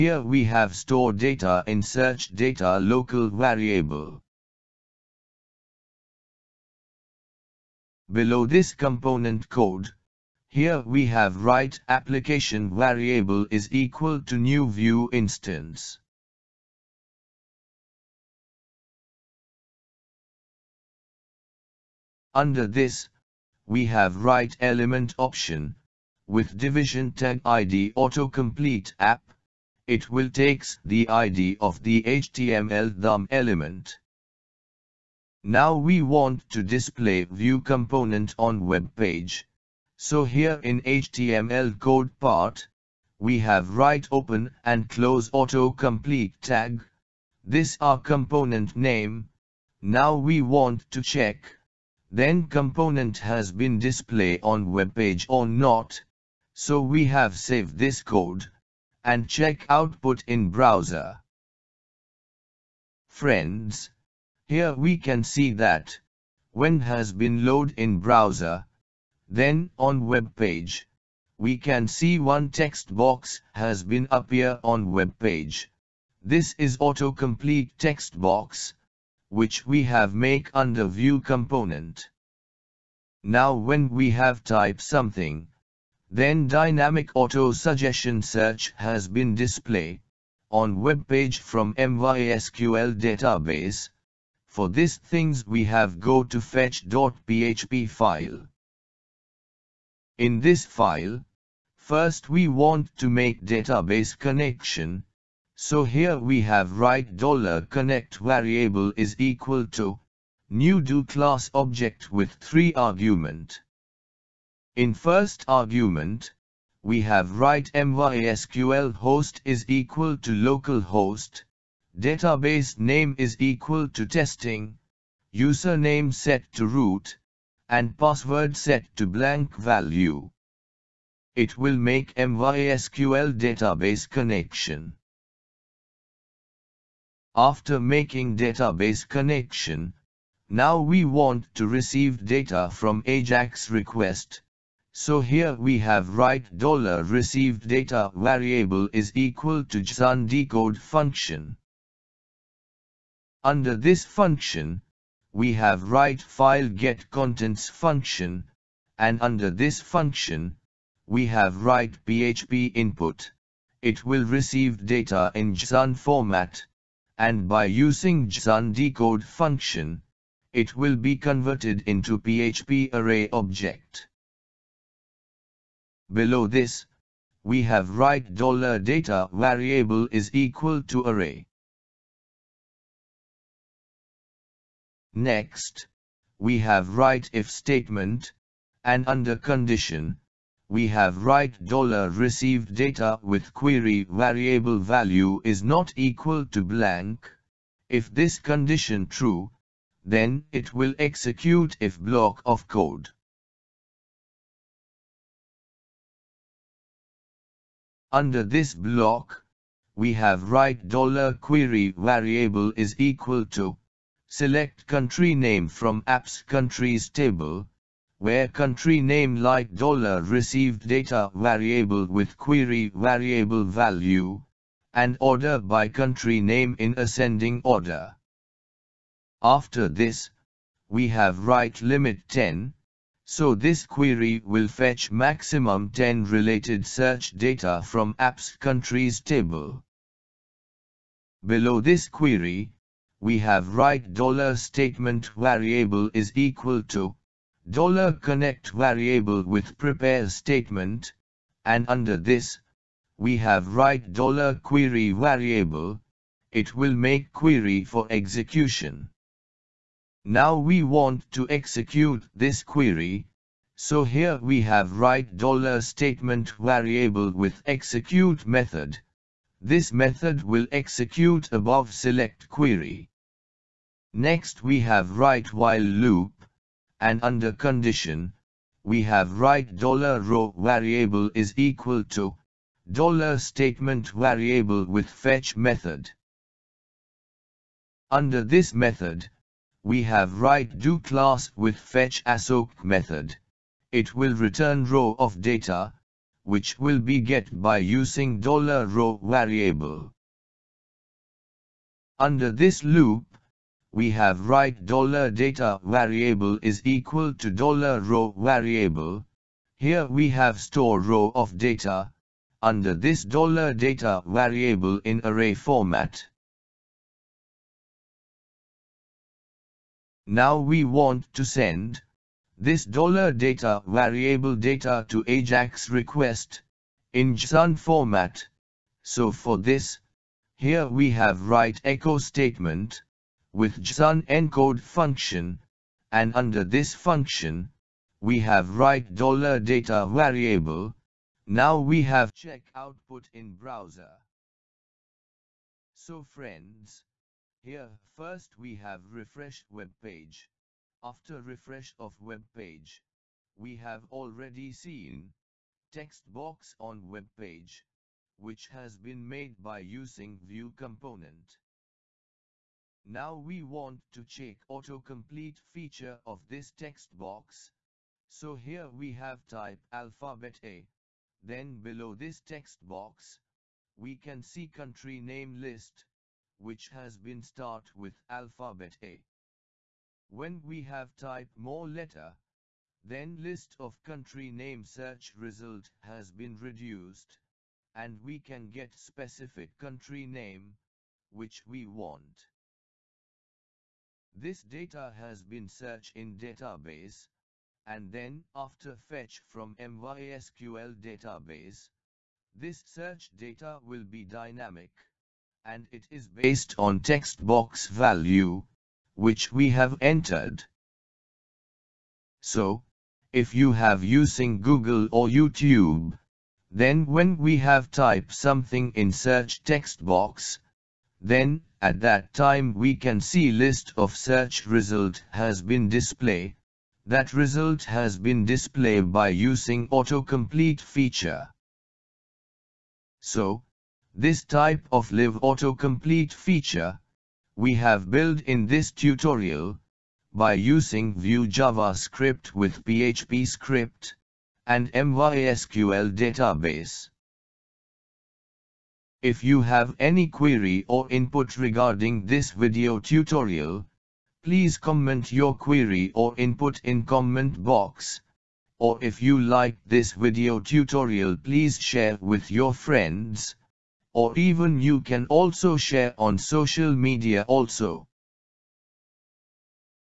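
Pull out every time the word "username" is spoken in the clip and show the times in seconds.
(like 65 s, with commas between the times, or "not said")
125 s.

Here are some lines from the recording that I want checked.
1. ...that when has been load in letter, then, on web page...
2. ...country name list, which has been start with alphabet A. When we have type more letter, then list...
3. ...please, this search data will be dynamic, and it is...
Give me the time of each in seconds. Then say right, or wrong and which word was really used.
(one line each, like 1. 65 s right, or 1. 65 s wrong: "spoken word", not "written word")
1. 65 s wrong: "browser", not "letter"
2. 374 s right
3. 401 s wrong: "database", not "please".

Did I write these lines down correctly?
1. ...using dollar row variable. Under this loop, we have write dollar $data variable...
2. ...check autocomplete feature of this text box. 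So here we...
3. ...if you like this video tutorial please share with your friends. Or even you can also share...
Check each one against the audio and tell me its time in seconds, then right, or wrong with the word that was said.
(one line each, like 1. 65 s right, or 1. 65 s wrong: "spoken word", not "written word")
1. 297 s right
2. 364 s right
3. 459 s right.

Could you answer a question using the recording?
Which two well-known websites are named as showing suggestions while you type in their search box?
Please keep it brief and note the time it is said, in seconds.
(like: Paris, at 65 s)
Google or YouTube, at 414 s.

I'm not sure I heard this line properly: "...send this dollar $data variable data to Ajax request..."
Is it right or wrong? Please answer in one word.
right.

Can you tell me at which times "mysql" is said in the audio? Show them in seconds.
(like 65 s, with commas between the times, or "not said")
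91 s, 117 s, 132 s, 399 s, 444 s.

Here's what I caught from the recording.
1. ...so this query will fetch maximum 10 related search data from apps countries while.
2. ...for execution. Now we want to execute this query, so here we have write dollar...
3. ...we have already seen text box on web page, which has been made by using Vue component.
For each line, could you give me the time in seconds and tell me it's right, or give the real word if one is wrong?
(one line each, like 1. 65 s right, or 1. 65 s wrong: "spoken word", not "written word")
1. 233 s wrong: "table", not "while"
2. 257 s right
3. 353 s right.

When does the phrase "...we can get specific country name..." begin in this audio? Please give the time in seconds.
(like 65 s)
388 s.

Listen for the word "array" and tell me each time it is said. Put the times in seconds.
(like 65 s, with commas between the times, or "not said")
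172 s, 181 s, 315 s.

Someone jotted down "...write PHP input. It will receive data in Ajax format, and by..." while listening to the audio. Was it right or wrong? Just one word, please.
wrong.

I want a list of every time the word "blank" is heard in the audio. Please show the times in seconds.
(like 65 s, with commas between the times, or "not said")
129 s, 196 s.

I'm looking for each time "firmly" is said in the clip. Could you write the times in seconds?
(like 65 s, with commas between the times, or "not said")
not said.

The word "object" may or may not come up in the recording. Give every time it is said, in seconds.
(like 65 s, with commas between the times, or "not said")
111 s, 173 s.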